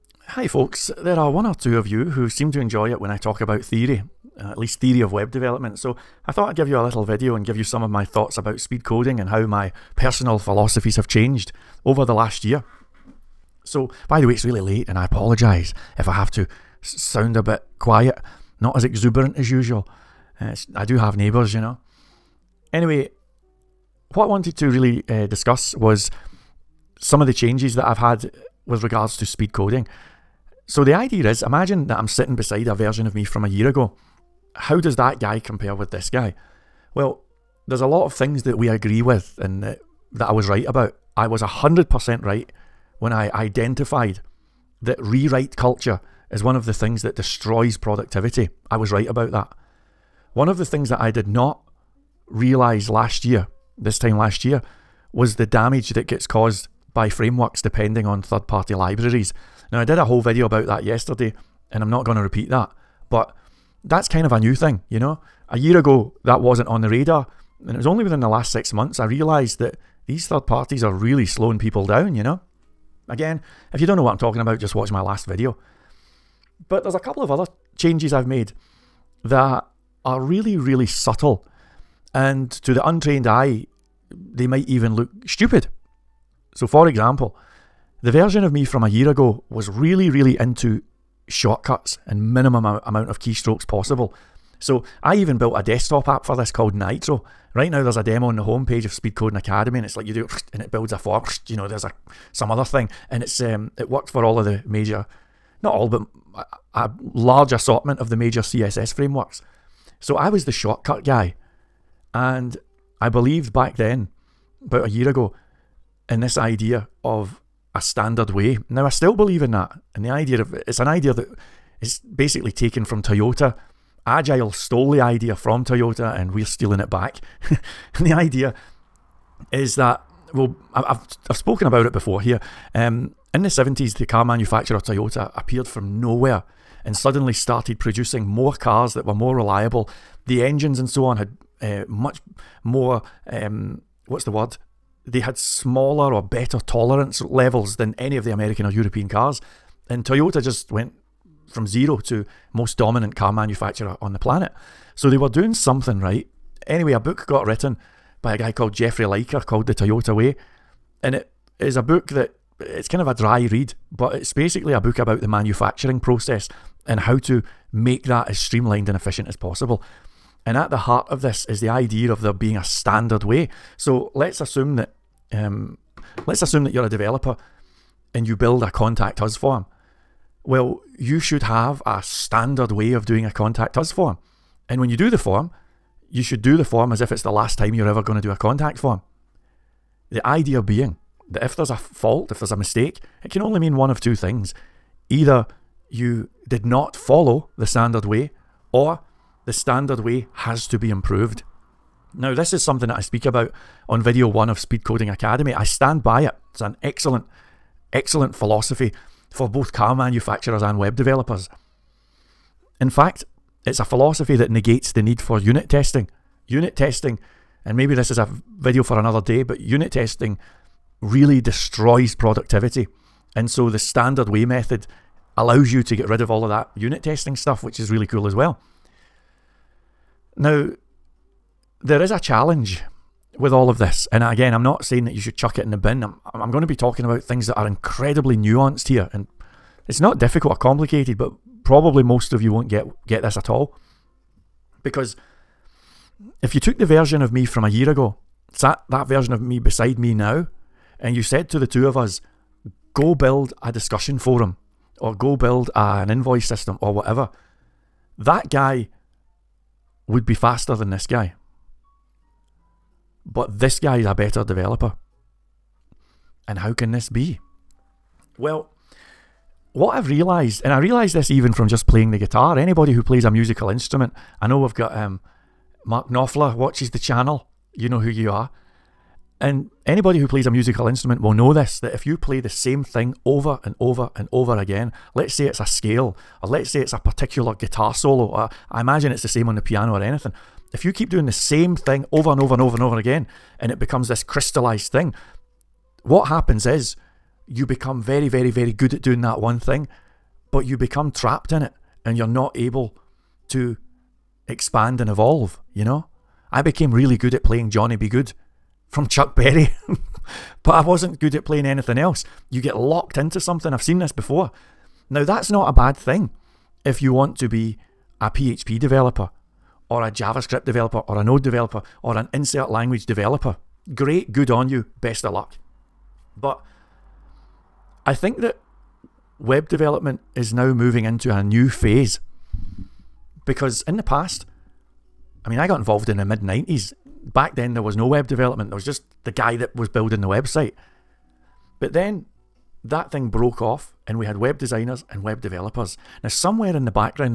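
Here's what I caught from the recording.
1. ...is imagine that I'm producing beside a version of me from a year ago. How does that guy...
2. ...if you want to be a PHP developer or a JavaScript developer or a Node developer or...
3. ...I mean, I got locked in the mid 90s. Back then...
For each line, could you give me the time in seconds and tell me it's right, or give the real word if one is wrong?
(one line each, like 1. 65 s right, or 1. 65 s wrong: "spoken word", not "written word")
1. 31 s wrong: "sitting", not "producing"
2. 316 s right
3. 335 s wrong: "involved", not "locked".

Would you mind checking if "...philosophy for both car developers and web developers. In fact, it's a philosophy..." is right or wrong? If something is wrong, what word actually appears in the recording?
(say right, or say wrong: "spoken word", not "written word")
wrong: "manufacturers", not "developers".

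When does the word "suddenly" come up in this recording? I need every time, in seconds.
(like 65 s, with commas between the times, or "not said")
136 s.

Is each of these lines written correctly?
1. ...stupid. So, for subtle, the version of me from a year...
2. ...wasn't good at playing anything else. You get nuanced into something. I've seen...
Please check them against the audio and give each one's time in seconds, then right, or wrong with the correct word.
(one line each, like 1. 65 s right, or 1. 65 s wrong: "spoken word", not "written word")
1. 85 s wrong: "example", not "subtle"
2. 310 s wrong: "locked", not "nuanced".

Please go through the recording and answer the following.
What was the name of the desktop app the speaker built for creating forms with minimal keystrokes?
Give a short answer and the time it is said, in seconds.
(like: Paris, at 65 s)
Nitro, at 96 s.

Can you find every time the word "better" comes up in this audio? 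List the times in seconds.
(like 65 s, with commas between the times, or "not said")
146 s, 264 s.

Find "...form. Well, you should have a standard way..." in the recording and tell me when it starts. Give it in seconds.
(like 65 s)
179 s.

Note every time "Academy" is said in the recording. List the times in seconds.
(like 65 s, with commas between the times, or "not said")
99 s, 205 s.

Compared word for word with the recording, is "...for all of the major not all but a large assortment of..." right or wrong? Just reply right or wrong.
right.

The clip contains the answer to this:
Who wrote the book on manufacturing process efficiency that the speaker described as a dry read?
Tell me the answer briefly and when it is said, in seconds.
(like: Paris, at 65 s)
Jeffrey Liker, at 158 s.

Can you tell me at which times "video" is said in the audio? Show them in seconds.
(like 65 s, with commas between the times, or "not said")
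7 s, 60 s, 75 s, 204 s, 218 s.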